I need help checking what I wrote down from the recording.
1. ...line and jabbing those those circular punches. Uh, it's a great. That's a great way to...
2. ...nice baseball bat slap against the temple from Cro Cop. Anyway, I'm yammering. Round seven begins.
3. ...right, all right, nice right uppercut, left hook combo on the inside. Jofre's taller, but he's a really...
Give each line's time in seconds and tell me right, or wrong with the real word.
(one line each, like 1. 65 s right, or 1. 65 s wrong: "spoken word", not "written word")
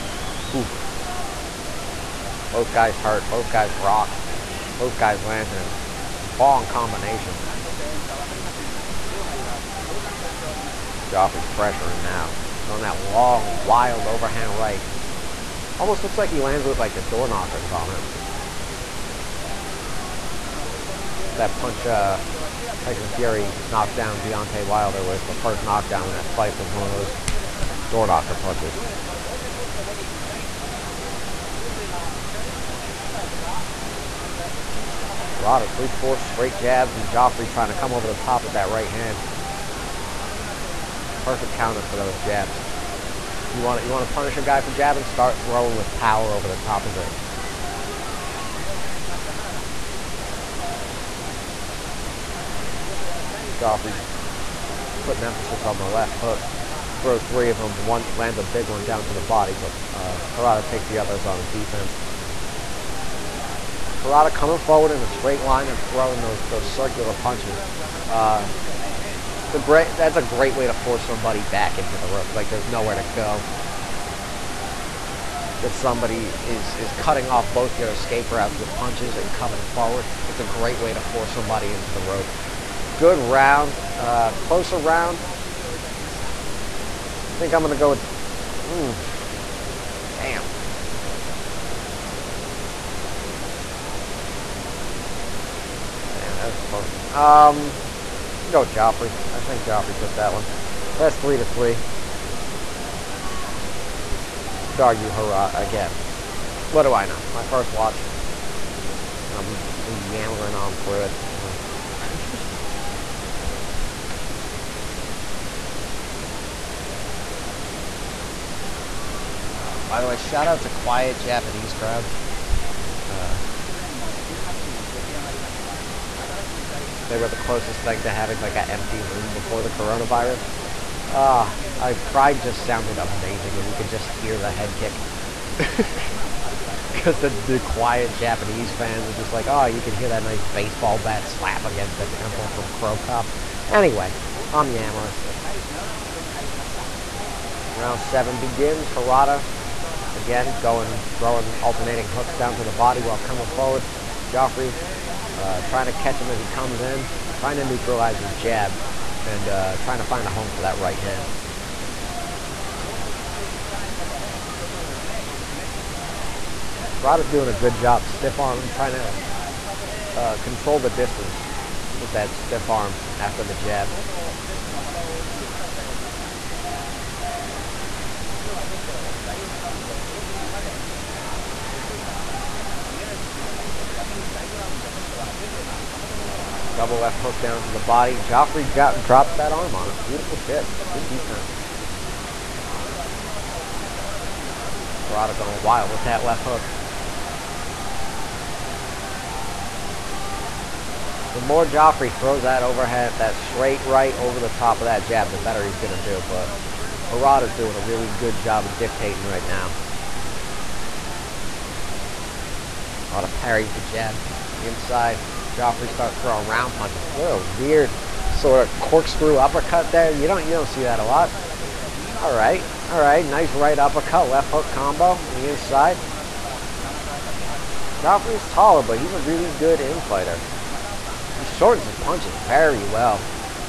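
1. 65 s wrong: "throwing", not "jabbing"
2. 140 s right
3. 222 s right.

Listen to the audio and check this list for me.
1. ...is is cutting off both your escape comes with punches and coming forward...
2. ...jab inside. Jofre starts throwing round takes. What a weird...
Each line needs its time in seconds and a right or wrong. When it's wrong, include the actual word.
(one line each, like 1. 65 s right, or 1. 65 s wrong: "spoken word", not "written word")
1. 76 s wrong: "routes", not "comes"
2. 213 s wrong: "punches", not "takes".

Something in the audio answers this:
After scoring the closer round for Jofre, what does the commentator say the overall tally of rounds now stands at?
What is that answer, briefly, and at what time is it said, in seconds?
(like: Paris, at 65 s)
3 to 3, at 101 s.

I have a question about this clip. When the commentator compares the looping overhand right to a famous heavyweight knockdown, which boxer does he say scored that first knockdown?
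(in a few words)
Tyson Fury.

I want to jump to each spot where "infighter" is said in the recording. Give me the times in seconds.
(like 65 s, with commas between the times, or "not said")
229 s.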